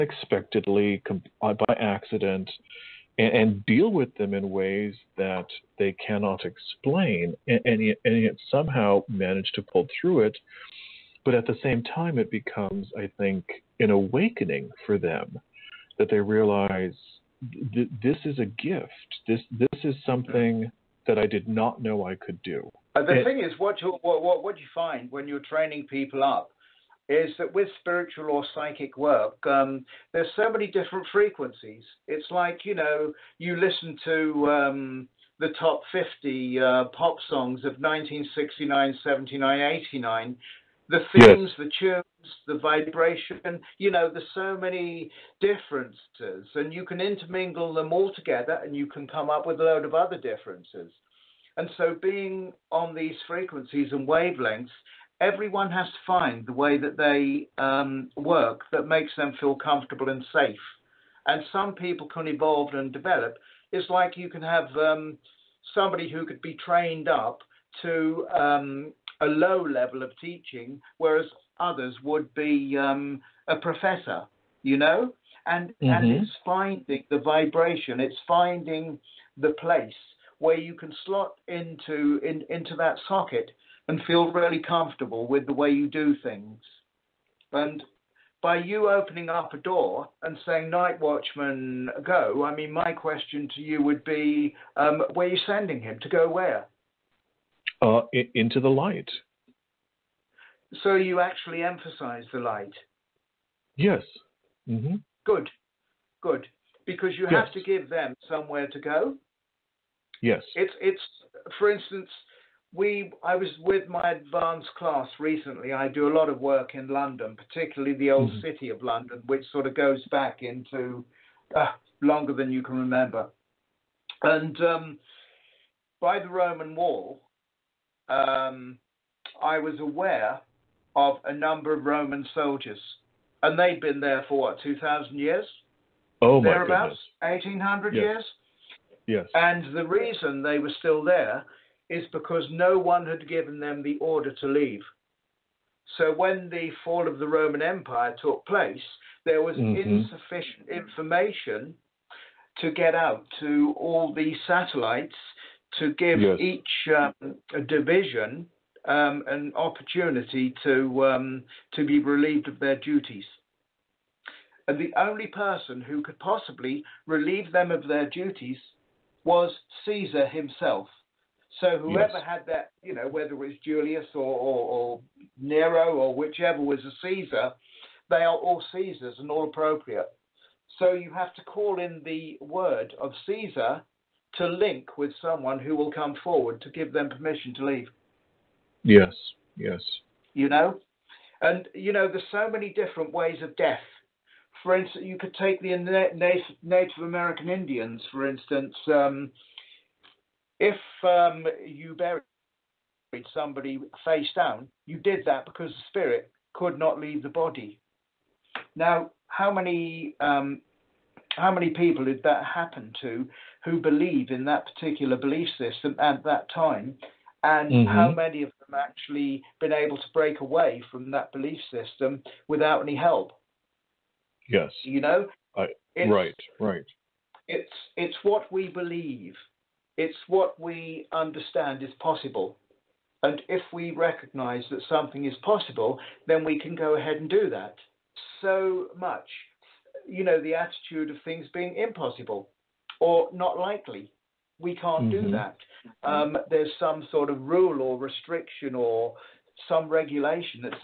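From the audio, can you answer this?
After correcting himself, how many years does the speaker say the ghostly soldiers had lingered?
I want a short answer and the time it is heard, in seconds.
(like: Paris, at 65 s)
1,800, at 137 s.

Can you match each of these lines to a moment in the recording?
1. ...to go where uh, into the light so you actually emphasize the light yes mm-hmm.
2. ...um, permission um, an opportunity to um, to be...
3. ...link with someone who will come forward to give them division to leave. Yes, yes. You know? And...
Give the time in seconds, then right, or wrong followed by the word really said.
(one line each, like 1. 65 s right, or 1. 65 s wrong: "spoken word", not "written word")
1. 96 s right
2. 156 s wrong: "division", not "permission"
3. 184 s wrong: "permission", not "division".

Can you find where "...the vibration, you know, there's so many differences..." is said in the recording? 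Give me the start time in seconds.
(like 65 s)
42 s.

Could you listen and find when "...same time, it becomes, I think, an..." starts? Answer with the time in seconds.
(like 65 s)
11 s.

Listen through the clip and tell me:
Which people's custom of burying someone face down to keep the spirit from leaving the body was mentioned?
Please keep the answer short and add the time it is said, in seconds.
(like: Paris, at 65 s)
Native American Indians, at 196 s.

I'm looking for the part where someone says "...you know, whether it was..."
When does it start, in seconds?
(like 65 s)
172 s.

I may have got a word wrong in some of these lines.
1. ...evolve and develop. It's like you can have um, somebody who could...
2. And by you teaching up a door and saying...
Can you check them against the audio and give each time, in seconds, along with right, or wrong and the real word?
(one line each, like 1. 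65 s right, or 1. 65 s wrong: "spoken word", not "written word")
1. 62 s right
2. 87 s wrong: "opening", not "teaching".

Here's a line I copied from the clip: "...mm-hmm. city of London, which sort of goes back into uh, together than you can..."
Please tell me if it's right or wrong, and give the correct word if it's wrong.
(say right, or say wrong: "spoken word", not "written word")
wrong: "longer", not "together".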